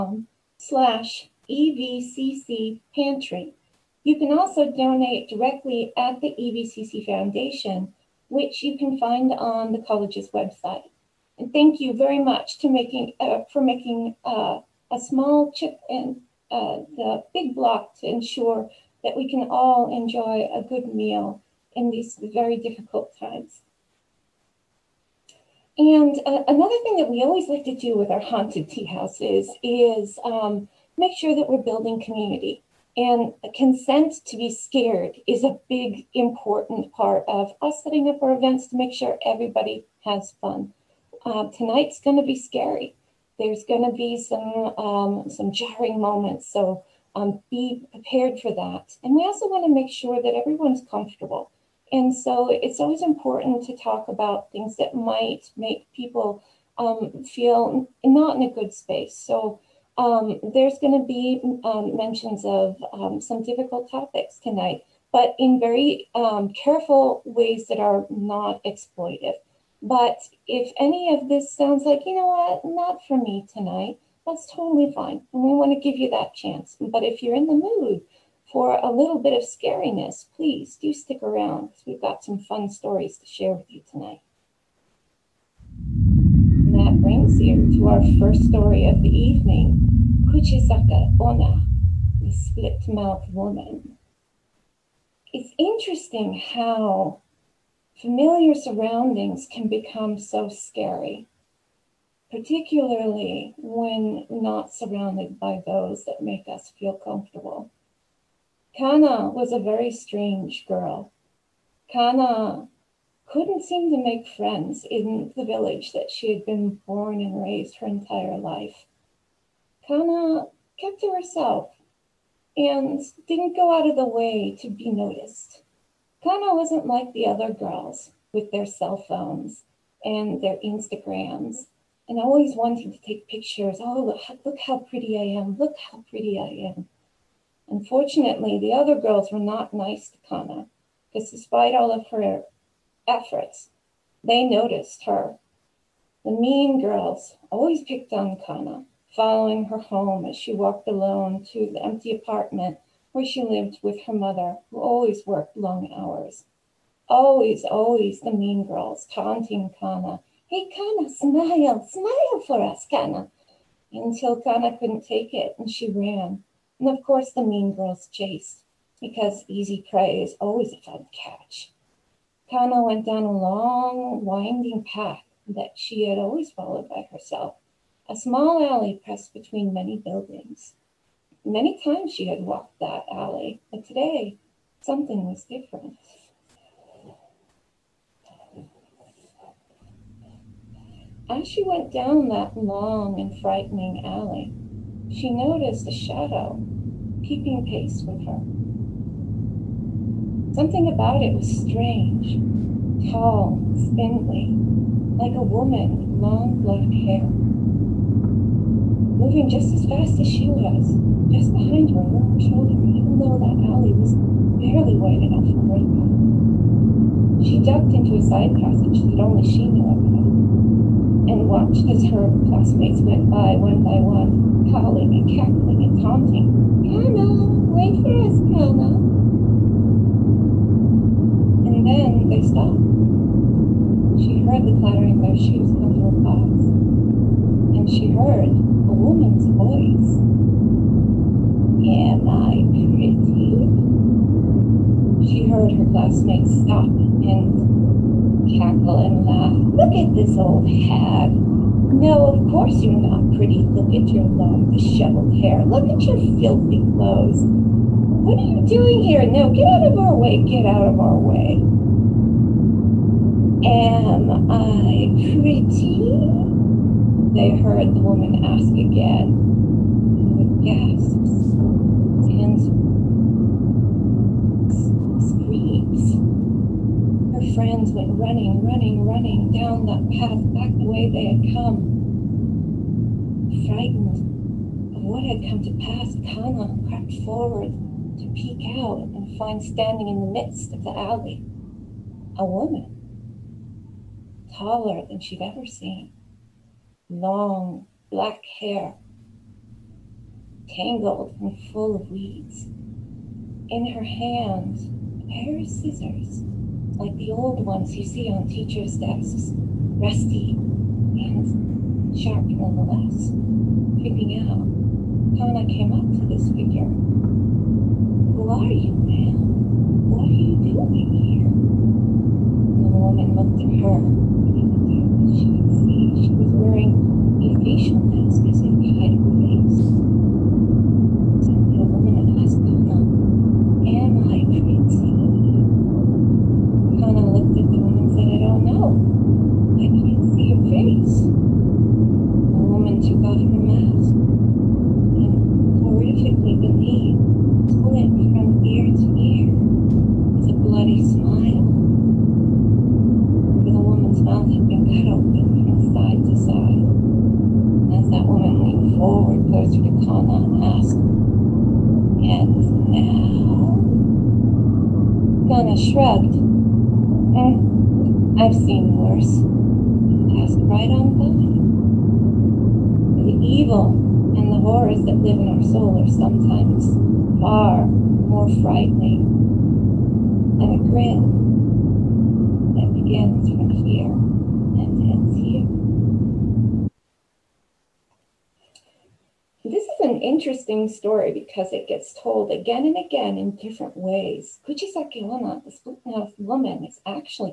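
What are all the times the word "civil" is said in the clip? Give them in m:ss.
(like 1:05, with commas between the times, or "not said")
not said.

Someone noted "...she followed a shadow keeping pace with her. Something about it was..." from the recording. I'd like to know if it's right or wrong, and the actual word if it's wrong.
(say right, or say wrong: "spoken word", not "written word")
wrong: "noticed", not "followed".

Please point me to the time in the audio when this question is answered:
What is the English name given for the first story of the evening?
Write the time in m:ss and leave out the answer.
1:32.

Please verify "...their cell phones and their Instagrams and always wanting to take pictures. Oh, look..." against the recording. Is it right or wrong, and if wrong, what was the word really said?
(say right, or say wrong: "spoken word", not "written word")
right.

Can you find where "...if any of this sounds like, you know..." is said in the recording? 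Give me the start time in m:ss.
1:10.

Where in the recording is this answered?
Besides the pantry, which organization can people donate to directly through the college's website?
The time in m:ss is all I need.
0:06.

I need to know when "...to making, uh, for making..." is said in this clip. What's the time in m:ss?
0:12.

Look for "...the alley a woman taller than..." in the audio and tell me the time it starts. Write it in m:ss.
4:50.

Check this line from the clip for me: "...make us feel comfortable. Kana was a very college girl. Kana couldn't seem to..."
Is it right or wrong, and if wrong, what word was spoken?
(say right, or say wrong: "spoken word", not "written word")
wrong: "strange", not "college".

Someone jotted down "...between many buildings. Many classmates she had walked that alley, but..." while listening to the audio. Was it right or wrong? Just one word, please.
wrong.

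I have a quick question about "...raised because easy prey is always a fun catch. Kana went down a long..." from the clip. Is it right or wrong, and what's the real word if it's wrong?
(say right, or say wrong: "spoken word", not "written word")
wrong: "chased", not "raised".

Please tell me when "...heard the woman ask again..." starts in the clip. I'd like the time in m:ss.
4:27.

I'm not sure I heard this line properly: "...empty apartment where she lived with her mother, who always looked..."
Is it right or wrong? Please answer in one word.
wrong.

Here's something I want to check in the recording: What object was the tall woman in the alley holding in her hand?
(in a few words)
Scissors.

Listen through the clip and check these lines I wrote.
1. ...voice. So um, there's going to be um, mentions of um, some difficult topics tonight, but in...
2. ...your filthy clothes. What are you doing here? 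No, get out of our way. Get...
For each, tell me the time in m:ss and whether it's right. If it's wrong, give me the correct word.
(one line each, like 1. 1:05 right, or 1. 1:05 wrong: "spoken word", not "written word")
1. 0:58 wrong: "space", not "voice"
2. 4:15 right.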